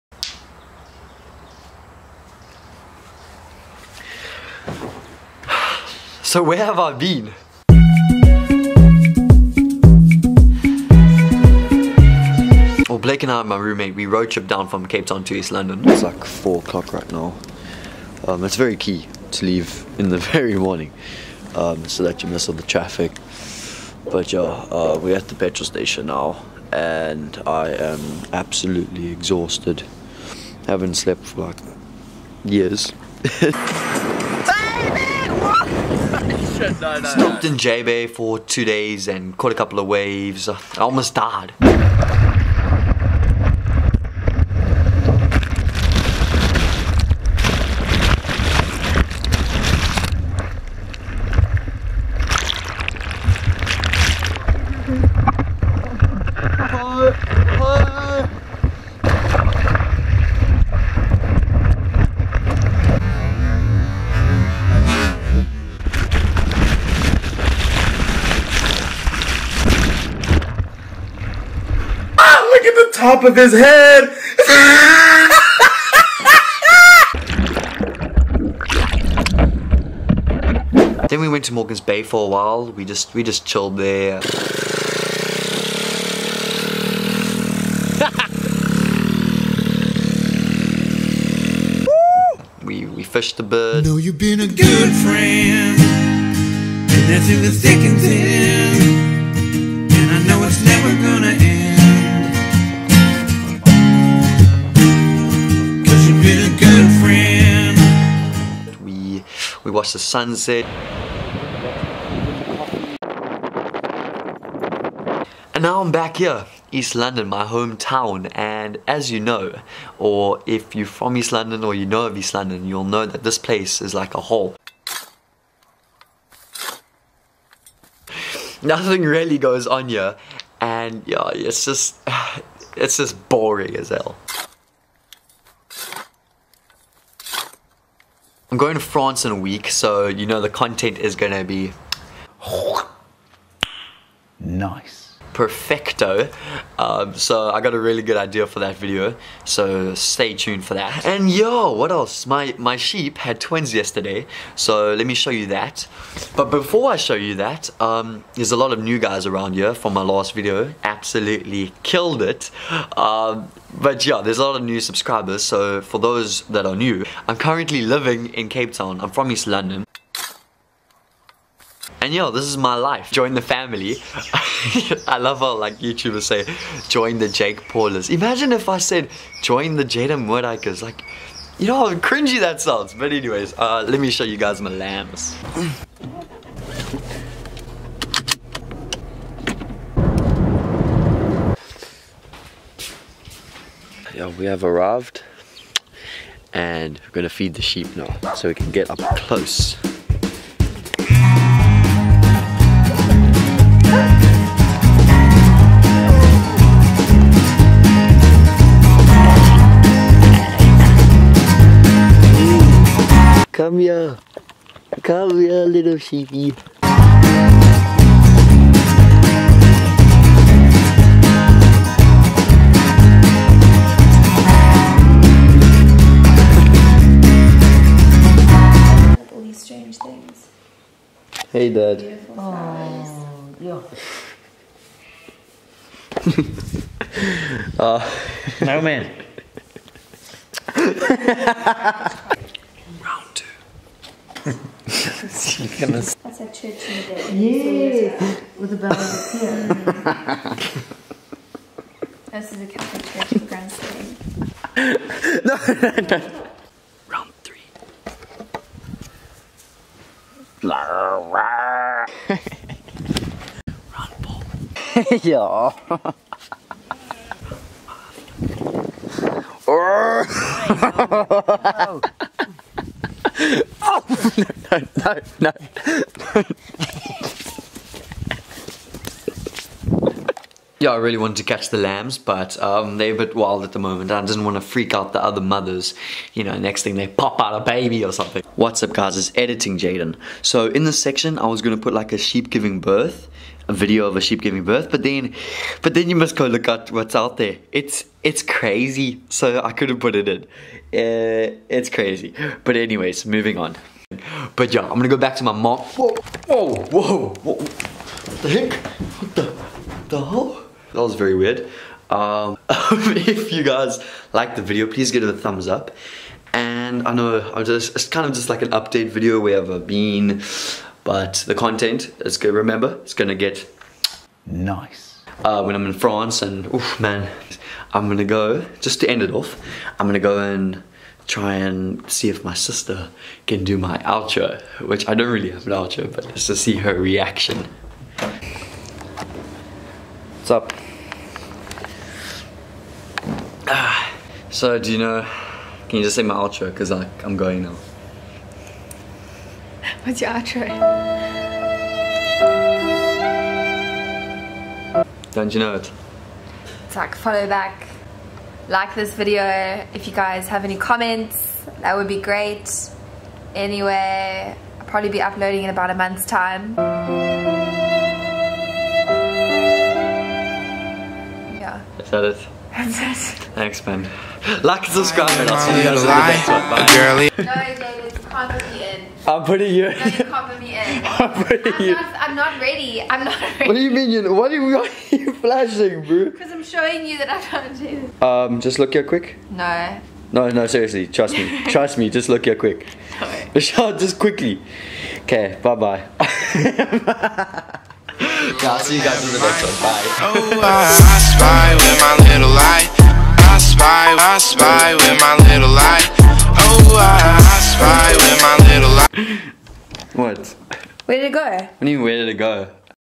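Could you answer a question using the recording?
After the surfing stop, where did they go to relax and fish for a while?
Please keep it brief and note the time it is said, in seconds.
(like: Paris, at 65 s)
Morgan's Bay, at 81 s.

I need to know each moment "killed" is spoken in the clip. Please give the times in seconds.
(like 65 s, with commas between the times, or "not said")
161 s.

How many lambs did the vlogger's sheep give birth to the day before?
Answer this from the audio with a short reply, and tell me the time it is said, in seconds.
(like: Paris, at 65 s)
2 (twins), at 153 s.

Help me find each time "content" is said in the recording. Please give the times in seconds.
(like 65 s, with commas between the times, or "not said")
140 s, 321 s.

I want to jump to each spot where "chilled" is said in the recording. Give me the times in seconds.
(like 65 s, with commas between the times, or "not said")
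83 s.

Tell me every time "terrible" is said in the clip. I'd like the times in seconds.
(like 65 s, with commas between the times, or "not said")
not said.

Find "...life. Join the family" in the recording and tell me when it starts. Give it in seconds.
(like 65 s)
172 s.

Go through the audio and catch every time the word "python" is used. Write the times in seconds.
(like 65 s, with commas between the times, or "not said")
not said.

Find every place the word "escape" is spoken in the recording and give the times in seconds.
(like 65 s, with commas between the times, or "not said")
not said.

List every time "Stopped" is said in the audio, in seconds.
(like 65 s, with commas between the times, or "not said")
37 s.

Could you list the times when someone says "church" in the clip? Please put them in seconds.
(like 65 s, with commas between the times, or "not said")
245 s, 253 s.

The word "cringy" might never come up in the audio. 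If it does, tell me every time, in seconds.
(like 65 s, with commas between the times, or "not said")
181 s.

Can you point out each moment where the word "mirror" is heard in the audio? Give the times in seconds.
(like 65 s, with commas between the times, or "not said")
not said.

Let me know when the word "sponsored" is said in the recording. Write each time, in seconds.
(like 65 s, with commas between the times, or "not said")
not said.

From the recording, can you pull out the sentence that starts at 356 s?
Zach, follow back, like this video.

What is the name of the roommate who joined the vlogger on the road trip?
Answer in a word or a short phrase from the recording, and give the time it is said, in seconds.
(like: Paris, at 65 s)
Blake, at 12 s.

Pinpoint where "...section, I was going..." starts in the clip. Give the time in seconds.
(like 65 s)
291 s.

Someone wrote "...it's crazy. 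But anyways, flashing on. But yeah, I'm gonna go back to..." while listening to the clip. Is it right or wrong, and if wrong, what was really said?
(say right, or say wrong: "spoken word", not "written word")
wrong: "moving", not "flashing".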